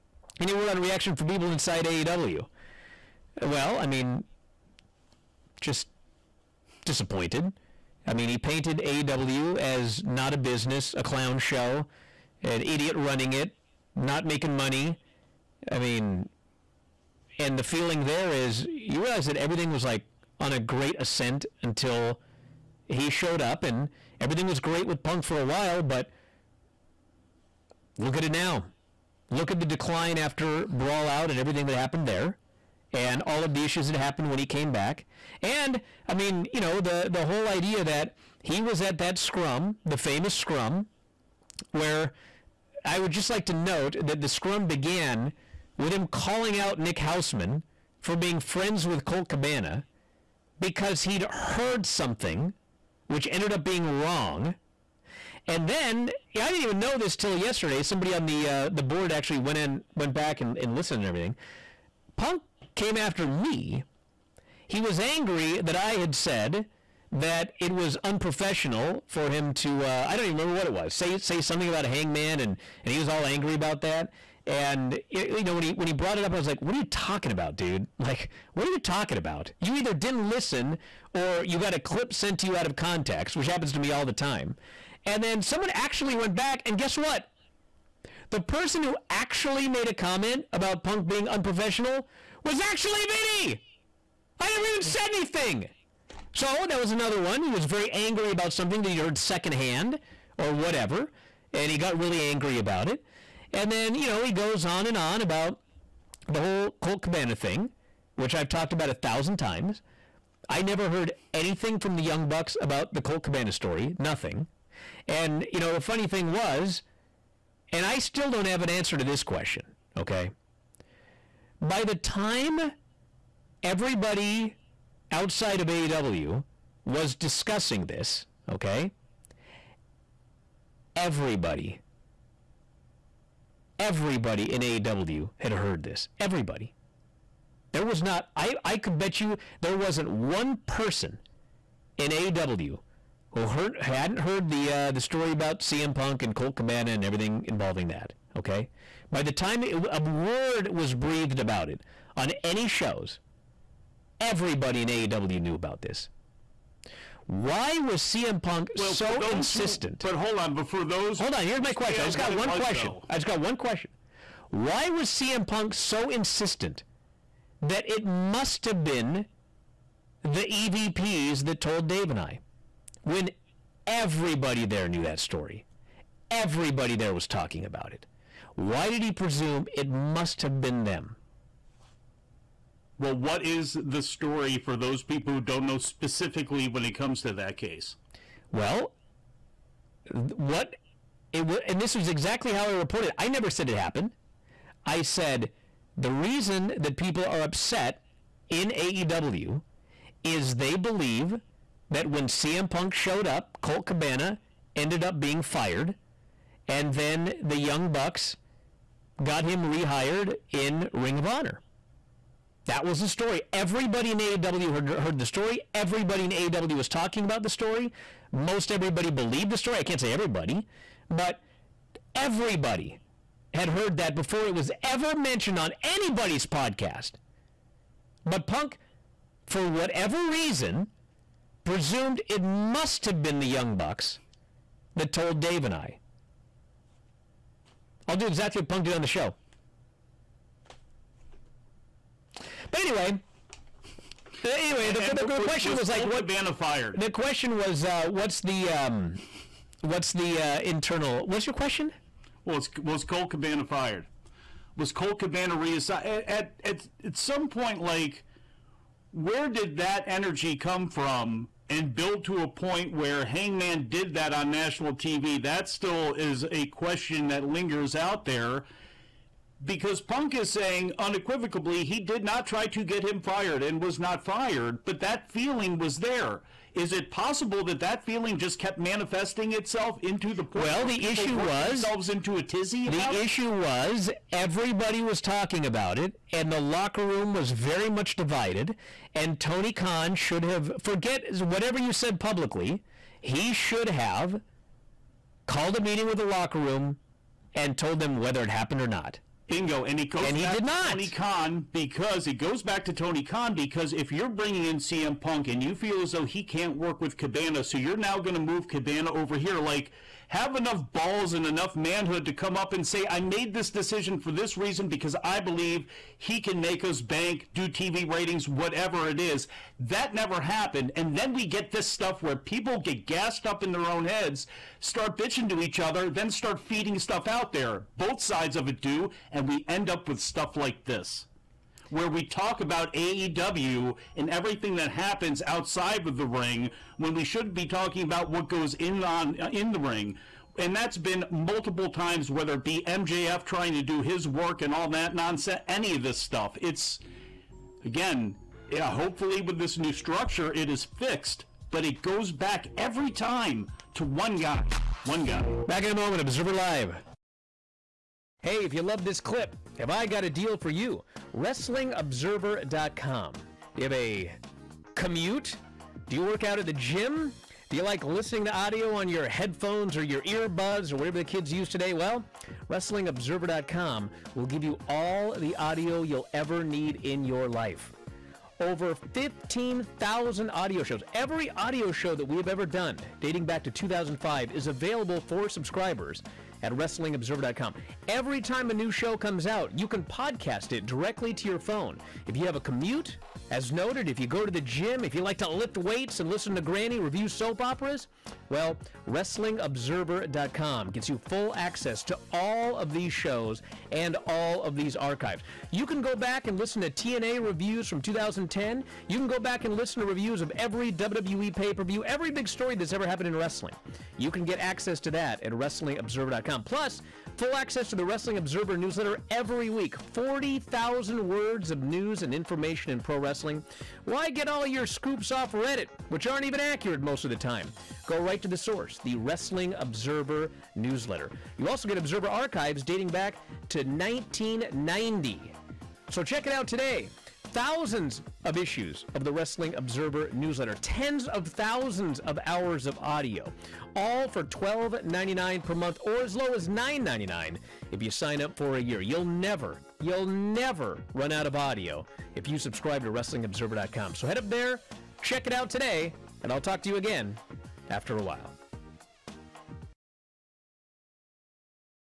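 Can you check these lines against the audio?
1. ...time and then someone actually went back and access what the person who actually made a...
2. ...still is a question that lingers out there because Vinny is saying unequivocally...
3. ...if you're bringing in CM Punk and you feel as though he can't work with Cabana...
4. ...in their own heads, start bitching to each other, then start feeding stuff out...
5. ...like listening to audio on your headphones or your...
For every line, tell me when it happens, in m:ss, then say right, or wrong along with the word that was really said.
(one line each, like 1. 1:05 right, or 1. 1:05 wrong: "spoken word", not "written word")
1. 1:24 wrong: "guess", not "access"
2. 4:25 wrong: "Punk", not "Vinny"
3. 5:03 right
4. 5:23 right
5. 6:07 right.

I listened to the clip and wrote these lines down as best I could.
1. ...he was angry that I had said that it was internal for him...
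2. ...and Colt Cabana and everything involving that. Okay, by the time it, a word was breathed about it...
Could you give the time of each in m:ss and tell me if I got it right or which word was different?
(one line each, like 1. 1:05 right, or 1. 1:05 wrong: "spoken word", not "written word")
1. 1:04 wrong: "unprofessional", not "internal"
2. 2:26 right.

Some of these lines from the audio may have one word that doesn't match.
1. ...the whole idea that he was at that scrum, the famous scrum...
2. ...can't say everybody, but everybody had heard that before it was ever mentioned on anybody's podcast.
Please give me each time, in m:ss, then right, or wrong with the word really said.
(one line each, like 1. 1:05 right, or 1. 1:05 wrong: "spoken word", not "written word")
1. 0:37 right
2. 3:39 right.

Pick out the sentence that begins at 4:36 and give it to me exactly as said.
Is it possible that that feeling just kept manifesting itself into the point?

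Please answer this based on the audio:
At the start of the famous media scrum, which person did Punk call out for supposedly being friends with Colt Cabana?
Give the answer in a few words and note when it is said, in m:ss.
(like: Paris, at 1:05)
Nick Hausman, at 0:46.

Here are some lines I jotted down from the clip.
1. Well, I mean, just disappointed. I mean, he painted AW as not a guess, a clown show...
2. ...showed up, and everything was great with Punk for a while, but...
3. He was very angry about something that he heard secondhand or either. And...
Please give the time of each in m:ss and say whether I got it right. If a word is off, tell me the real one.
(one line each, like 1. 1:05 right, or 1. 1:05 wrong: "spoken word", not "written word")
1. 0:03 wrong: "business", not "guess"
2. 0:23 right
3. 1:37 wrong: "whatever", not "either".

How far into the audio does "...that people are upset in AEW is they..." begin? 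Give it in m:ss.
3:16.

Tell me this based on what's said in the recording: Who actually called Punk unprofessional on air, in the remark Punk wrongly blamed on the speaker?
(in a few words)
Vinny.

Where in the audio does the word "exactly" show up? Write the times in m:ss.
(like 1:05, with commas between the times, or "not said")
3:12, 3:58.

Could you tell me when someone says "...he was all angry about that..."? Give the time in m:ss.
1:12.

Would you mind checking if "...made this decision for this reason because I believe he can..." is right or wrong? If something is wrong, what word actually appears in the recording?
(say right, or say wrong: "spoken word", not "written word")
right.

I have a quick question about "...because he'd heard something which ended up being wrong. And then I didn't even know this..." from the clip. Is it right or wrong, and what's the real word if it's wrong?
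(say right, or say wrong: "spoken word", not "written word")
right.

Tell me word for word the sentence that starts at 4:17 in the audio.
Like, where did that energy come from?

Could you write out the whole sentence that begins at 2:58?
Why did he presume it must have been them?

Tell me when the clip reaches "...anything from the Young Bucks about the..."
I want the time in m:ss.
1:51.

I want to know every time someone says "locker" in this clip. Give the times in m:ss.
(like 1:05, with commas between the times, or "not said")
4:46, 4:56.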